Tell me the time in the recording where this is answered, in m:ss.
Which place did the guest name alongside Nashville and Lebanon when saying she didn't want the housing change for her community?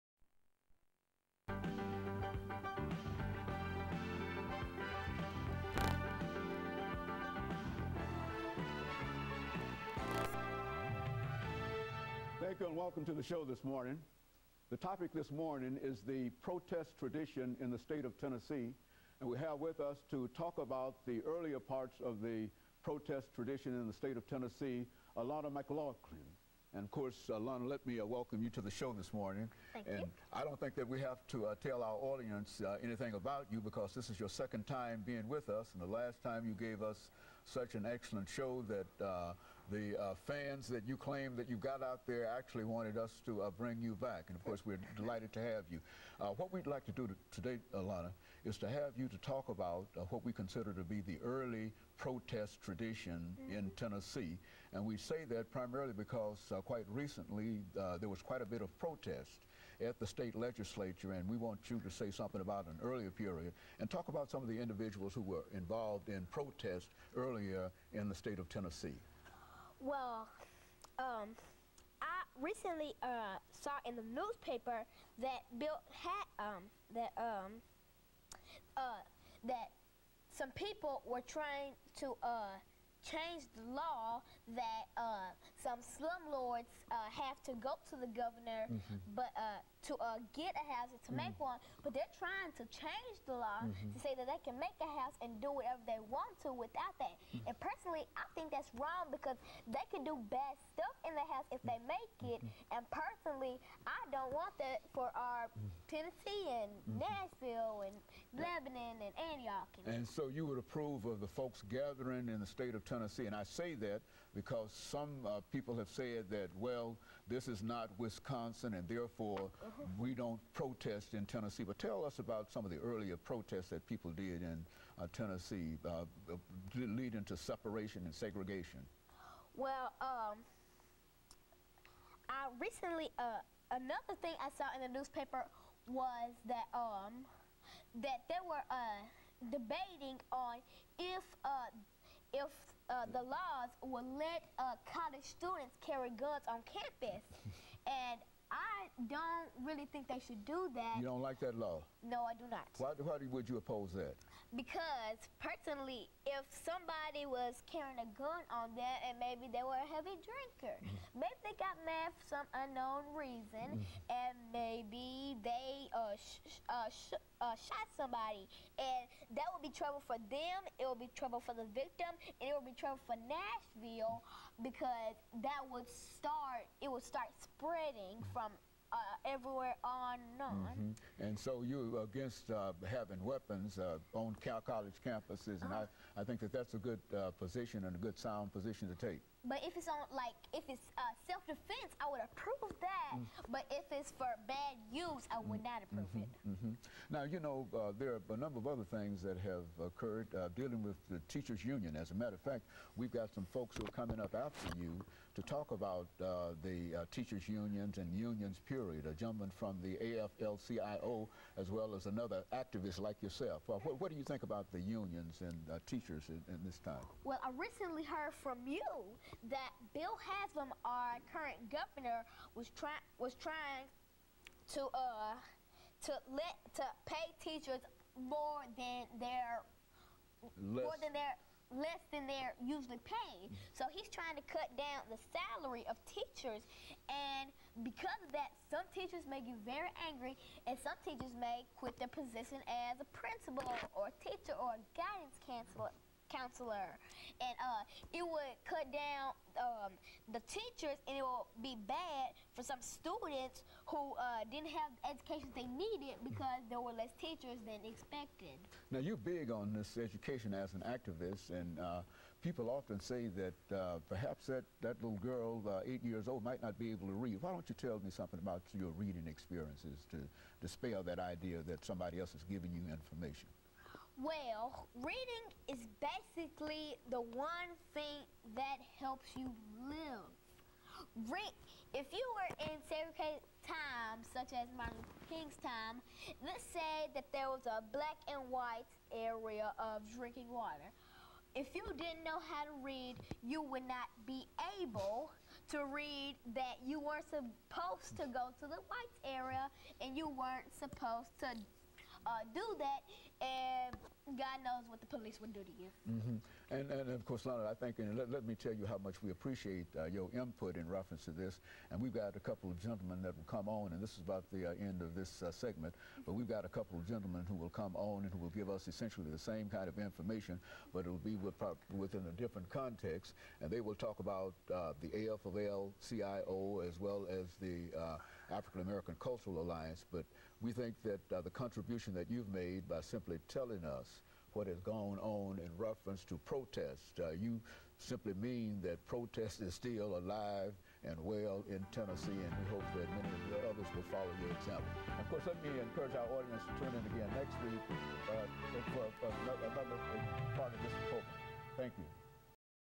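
1:49.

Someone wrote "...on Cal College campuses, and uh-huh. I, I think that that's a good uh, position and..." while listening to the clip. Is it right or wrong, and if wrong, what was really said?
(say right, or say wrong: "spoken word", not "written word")
right.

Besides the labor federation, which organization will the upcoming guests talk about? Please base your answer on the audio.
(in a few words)
African American Cultural Alliance.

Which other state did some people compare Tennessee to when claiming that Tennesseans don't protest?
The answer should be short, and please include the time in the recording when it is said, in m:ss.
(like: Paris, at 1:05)
Wisconsin, at 1:57.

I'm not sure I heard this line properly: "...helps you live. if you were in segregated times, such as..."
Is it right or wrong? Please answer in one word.
right.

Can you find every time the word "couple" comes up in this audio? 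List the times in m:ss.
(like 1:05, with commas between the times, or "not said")
5:12, 5:16.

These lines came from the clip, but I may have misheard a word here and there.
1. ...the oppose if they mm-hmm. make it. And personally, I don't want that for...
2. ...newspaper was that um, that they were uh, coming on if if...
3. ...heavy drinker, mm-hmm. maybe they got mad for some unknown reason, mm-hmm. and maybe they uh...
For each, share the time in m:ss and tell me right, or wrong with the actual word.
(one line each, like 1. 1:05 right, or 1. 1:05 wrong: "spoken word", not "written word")
1. 1:41 wrong: "house", not "oppose"
2. 2:14 wrong: "debating", not "coming"
3. 2:39 right.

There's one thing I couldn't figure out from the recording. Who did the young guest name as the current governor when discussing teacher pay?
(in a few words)
Bill Haslam.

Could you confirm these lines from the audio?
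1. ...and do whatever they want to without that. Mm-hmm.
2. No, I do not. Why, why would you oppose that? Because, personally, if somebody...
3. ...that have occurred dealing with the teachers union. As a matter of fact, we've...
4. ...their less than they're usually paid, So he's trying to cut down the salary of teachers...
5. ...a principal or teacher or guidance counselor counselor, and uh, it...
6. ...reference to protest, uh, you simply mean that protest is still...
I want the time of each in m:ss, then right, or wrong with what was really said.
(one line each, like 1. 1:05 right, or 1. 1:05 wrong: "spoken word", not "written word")
1. 1:35 right
2. 2:32 right
3. 3:19 right
4. 3:51 right
5. 4:02 right
6. 5:35 right.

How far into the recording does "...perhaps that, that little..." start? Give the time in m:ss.
4:24.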